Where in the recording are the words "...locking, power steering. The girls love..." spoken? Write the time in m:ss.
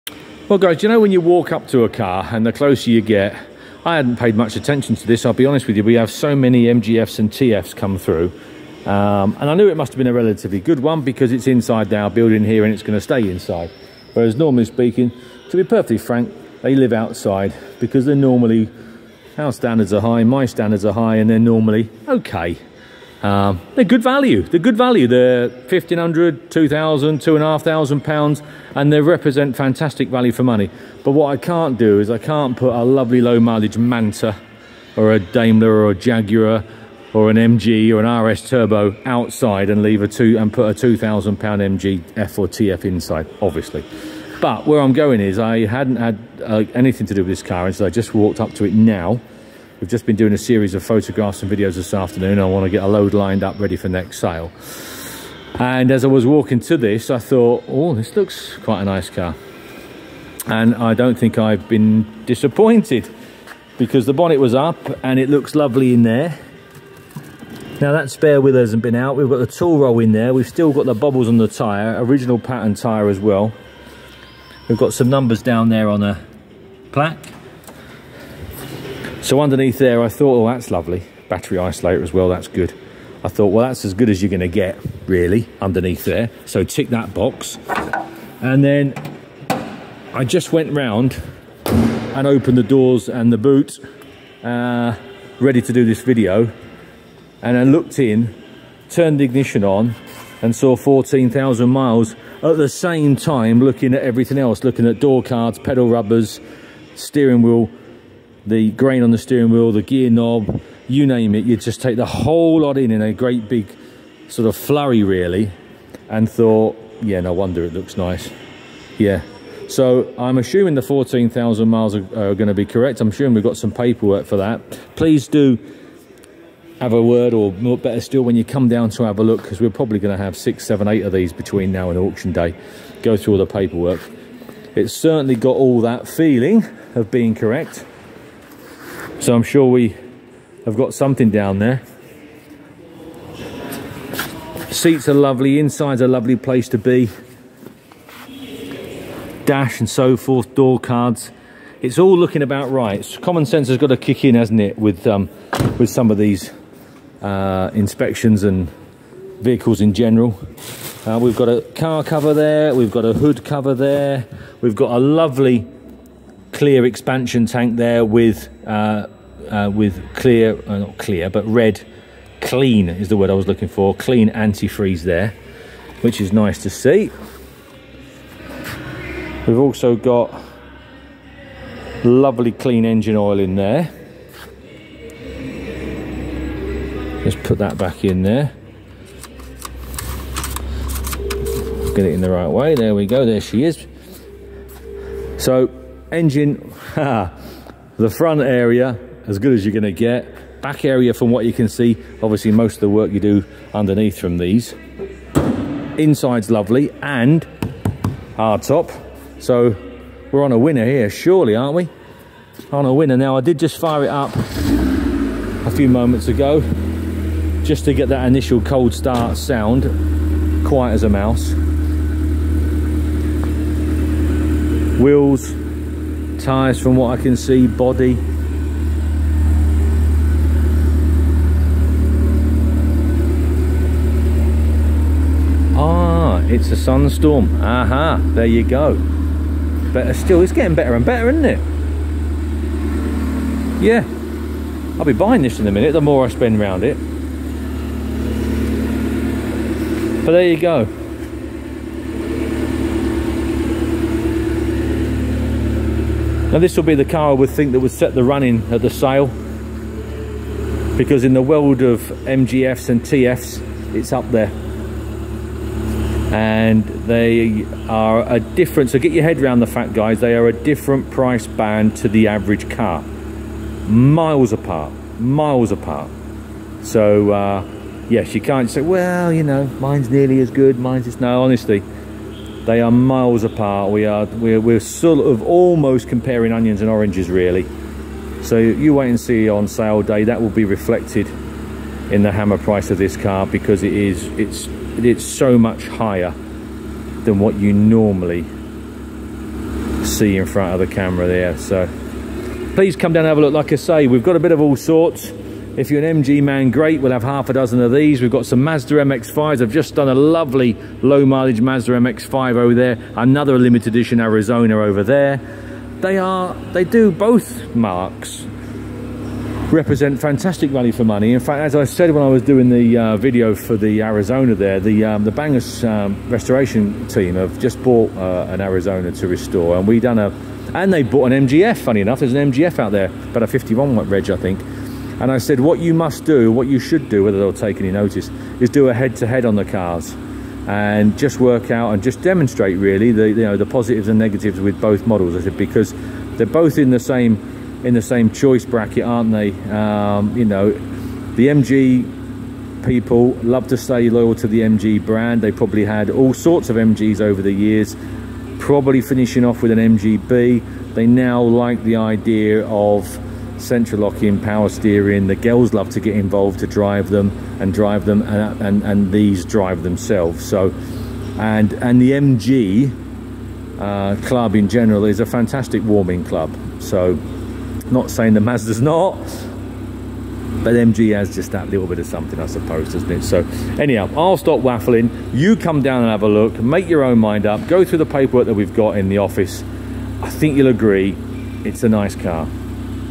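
6:04.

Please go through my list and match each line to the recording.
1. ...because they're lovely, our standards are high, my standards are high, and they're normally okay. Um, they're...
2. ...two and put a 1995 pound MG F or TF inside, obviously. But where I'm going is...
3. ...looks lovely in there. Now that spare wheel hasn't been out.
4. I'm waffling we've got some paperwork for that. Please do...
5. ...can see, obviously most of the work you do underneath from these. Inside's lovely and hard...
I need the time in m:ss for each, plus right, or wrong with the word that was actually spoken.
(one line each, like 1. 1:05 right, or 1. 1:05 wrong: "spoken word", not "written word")
1. 0:17 wrong: "normally", not "lovely"
2. 0:40 wrong: "2000", not "1995"
3. 1:05 right
4. 2:02 wrong: "assuming", not "waffling"
5. 3:21 right.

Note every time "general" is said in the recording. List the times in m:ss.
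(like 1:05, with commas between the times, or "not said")
2:39, 6:14.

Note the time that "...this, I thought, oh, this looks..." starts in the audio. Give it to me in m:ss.
0:56.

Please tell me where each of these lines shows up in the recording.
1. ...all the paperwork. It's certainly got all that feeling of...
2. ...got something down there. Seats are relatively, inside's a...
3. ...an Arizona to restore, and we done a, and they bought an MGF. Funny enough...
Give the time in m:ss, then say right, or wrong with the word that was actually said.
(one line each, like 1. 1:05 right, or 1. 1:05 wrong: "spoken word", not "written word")
1. 2:13 right
2. 2:20 wrong: "lovely", not "relatively"
3. 5:28 right.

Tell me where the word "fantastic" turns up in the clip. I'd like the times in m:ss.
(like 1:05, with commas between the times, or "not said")
0:29, 5:20, 6:15.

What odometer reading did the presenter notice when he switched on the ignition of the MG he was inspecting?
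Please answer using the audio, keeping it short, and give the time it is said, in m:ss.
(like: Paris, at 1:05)
14,000 miles, at 1:40.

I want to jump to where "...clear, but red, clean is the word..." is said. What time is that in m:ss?
2:50.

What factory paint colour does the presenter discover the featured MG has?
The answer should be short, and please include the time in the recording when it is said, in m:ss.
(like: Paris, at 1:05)
Sunstorm, at 3:56.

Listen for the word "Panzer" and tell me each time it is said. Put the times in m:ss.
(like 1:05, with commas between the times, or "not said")
not said.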